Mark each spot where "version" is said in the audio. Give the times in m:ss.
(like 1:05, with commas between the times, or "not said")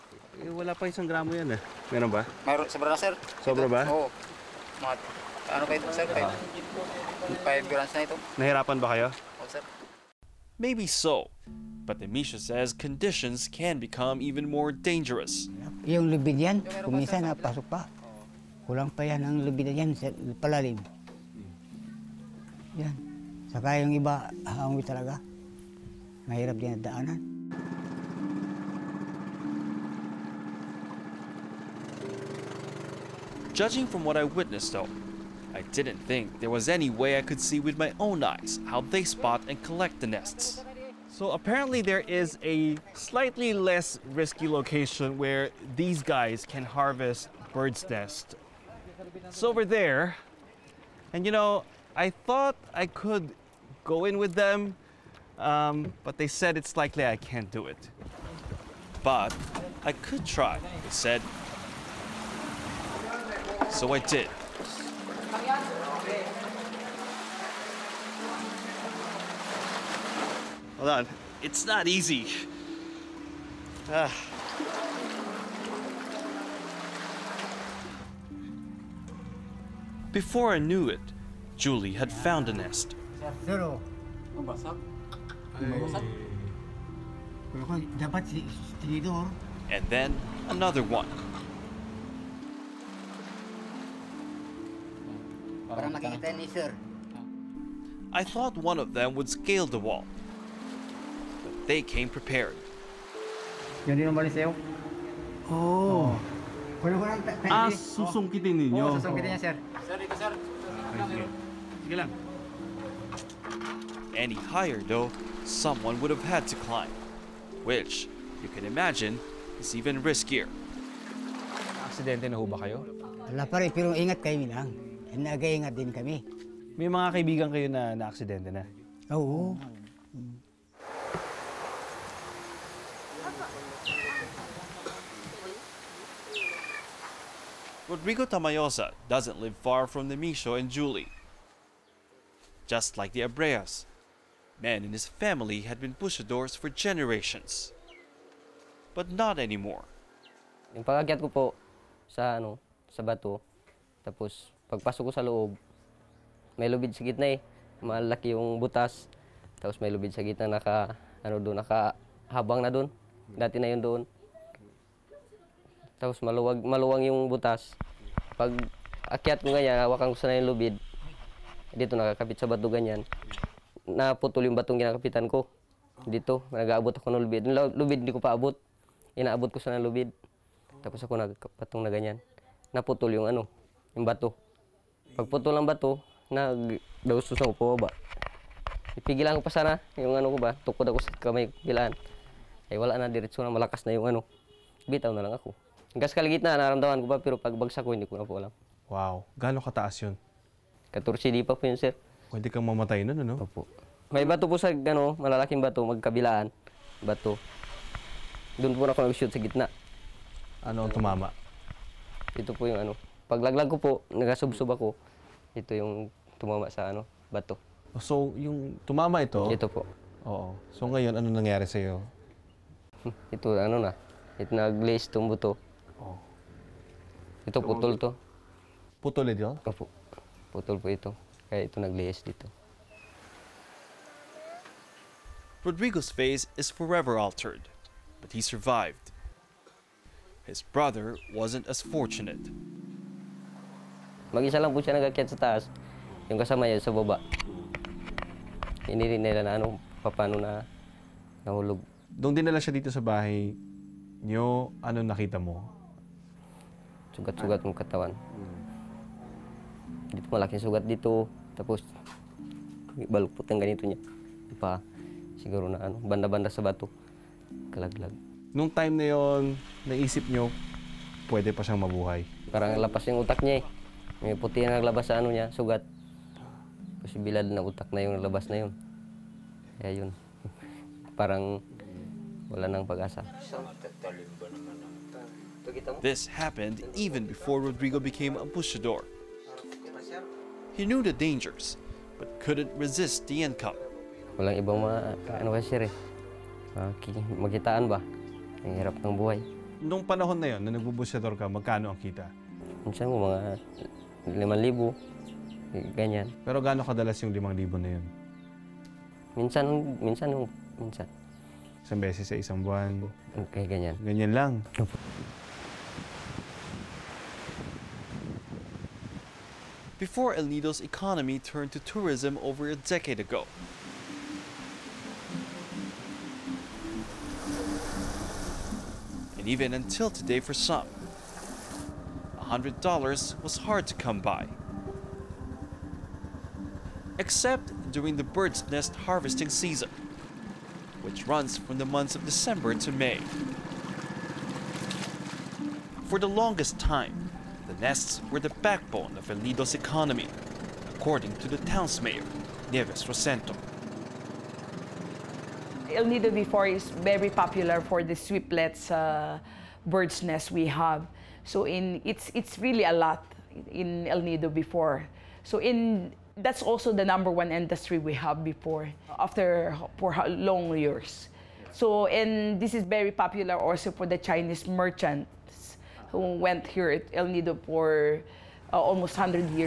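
not said.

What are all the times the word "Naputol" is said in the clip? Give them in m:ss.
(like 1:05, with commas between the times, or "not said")
2:53, 3:02.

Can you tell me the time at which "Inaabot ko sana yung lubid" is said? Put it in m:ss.
2:59.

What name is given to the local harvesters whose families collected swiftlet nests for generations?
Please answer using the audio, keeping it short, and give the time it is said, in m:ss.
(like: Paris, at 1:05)
pushadors, at 2:25.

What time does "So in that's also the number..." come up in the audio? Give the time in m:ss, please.
6:05.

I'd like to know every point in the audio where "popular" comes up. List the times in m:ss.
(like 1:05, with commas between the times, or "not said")
5:57, 6:13.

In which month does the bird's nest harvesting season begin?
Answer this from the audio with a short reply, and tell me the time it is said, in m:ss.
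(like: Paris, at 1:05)
December, at 5:42.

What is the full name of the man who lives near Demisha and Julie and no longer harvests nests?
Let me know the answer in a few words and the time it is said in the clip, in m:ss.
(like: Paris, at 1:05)
Rodrigo Tamayosa, at 2:17.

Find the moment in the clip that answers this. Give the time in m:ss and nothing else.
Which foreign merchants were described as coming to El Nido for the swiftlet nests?
6:14.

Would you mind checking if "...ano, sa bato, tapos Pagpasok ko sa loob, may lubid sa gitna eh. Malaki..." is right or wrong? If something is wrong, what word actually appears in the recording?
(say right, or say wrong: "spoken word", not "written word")
right.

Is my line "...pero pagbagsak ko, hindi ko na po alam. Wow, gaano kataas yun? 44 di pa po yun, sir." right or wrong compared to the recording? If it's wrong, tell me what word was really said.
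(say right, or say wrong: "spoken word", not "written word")
wrong: "14", not "44".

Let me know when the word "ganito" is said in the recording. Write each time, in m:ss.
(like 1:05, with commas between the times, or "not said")
4:23.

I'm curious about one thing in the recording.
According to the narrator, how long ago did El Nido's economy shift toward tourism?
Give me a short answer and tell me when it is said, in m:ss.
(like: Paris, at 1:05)
over a decade ago, at 5:22.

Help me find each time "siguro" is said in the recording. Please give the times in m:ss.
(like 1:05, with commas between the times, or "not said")
4:25.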